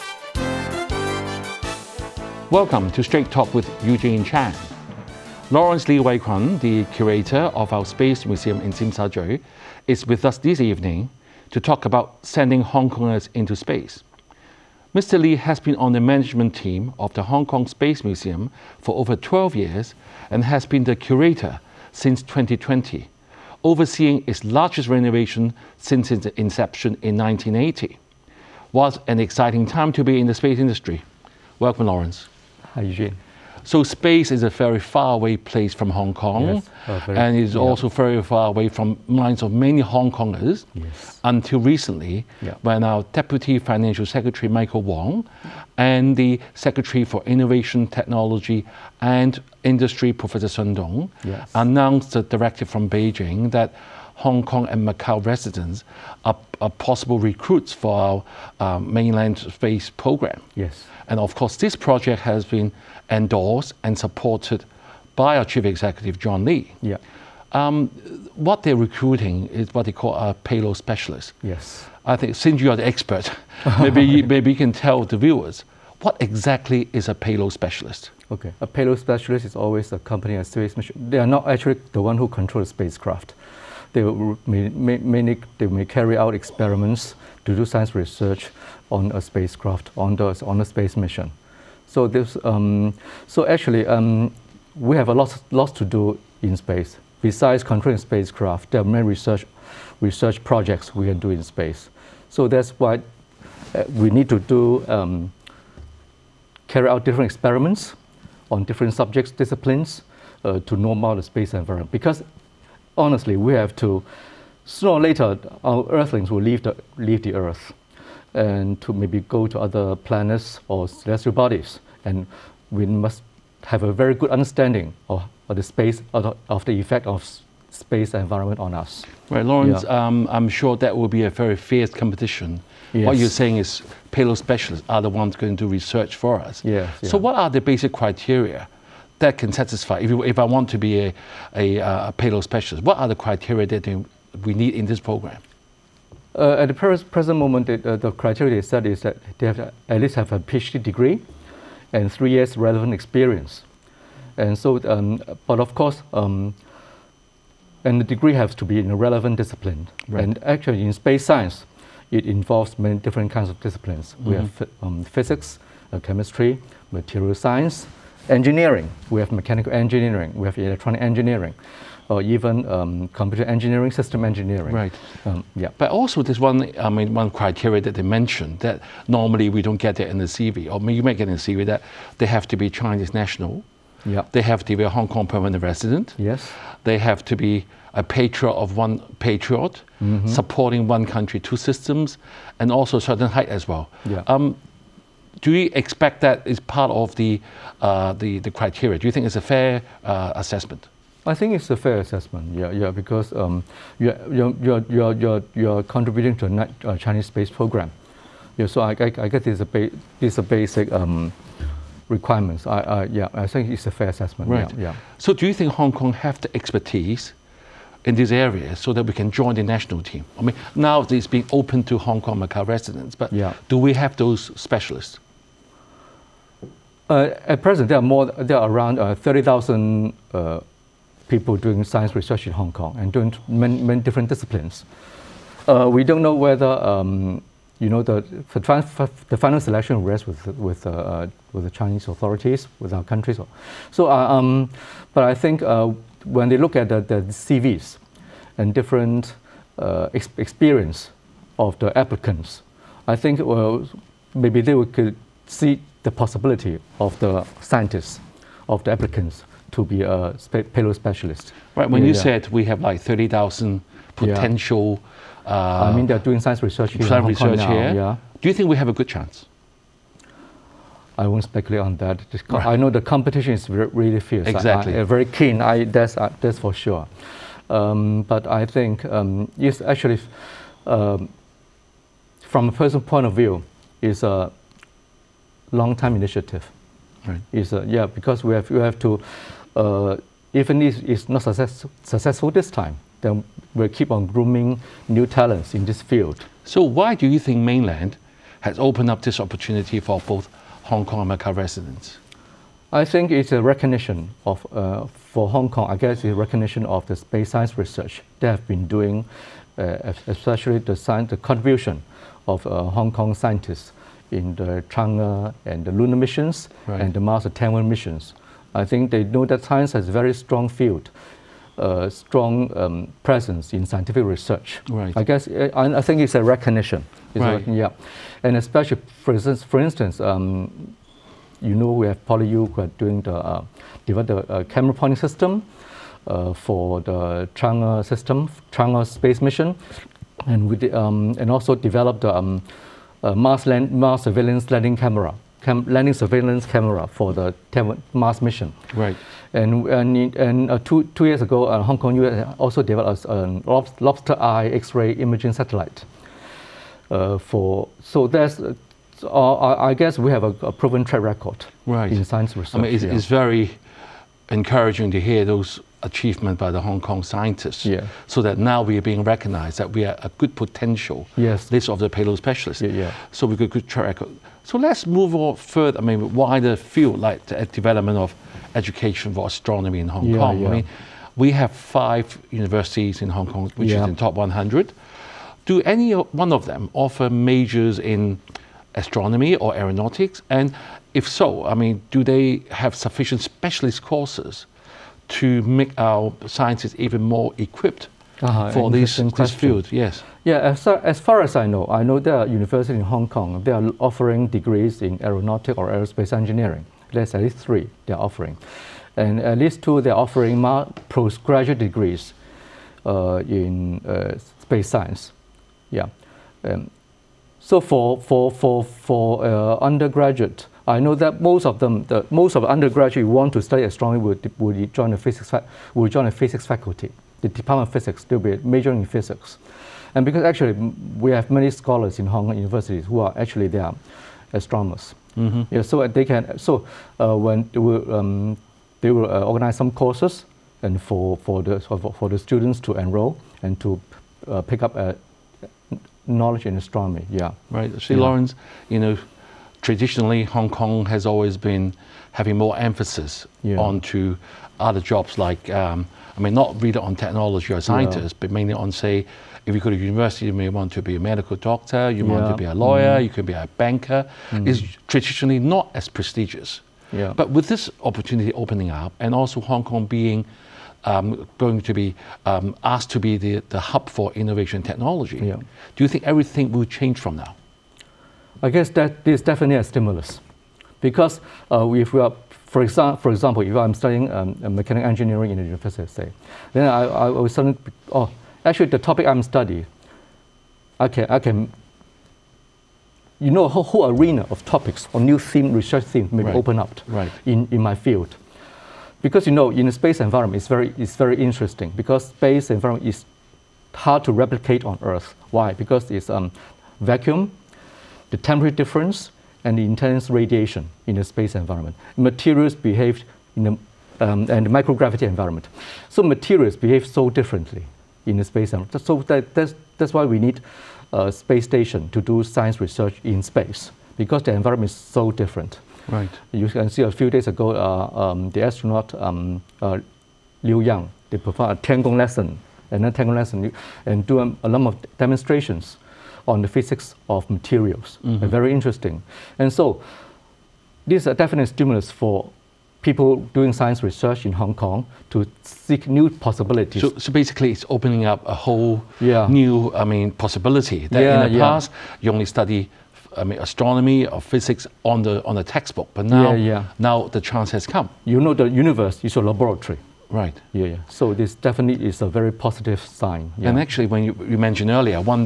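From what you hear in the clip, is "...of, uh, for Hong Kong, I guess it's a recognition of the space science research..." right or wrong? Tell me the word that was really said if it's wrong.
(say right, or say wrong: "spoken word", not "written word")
right.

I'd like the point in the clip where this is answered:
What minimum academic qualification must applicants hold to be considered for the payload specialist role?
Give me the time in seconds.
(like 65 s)
150 s.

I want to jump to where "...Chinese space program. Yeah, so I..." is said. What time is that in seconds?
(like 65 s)
206 s.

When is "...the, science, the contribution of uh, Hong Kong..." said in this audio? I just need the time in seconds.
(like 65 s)
310 s.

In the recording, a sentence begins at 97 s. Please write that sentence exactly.
Besides controlling spacecraft, there are many research, research projects we can do in space.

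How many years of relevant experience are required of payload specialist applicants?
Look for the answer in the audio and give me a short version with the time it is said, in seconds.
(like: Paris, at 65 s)
3, at 152 s.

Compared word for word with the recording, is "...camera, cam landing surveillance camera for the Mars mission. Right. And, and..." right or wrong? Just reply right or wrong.
right.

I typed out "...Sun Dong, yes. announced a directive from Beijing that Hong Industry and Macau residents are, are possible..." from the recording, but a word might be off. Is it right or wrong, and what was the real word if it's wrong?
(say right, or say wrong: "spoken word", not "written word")
wrong: "Kong", not "Industry".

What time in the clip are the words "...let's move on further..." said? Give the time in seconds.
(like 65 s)
374 s.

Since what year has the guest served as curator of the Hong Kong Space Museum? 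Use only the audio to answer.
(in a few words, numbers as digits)
2020.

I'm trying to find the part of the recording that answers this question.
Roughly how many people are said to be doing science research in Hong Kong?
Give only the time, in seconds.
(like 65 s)
229 s.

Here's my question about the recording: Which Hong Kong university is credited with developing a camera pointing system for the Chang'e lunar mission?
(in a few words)
PolyU.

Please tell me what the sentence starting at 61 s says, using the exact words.
And of course, this project has been endorsed and supported by our chief executive, John Lee.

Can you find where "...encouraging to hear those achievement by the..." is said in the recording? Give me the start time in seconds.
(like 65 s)
364 s.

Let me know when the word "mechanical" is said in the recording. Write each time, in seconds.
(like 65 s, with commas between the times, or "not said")
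169 s, 484 s.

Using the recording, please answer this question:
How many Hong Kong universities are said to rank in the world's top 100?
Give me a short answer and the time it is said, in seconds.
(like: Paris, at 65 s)
5, at 381 s.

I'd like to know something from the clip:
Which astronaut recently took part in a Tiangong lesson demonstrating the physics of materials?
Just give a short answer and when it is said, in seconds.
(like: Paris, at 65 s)
Liu Yang, at 530 s.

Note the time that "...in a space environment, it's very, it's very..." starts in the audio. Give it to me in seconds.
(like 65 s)
499 s.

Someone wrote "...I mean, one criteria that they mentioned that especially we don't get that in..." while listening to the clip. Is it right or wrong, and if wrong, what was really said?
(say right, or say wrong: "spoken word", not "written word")
wrong: "normally", not "especially".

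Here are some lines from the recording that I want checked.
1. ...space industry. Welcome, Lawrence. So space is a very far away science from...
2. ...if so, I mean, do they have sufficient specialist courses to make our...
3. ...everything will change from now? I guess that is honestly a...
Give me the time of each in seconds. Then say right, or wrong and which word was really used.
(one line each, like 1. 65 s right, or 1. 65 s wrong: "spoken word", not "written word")
1. 30 s wrong: "place", not "science"
2. 391 s right
3. 476 s wrong: "definitely", not "honestly".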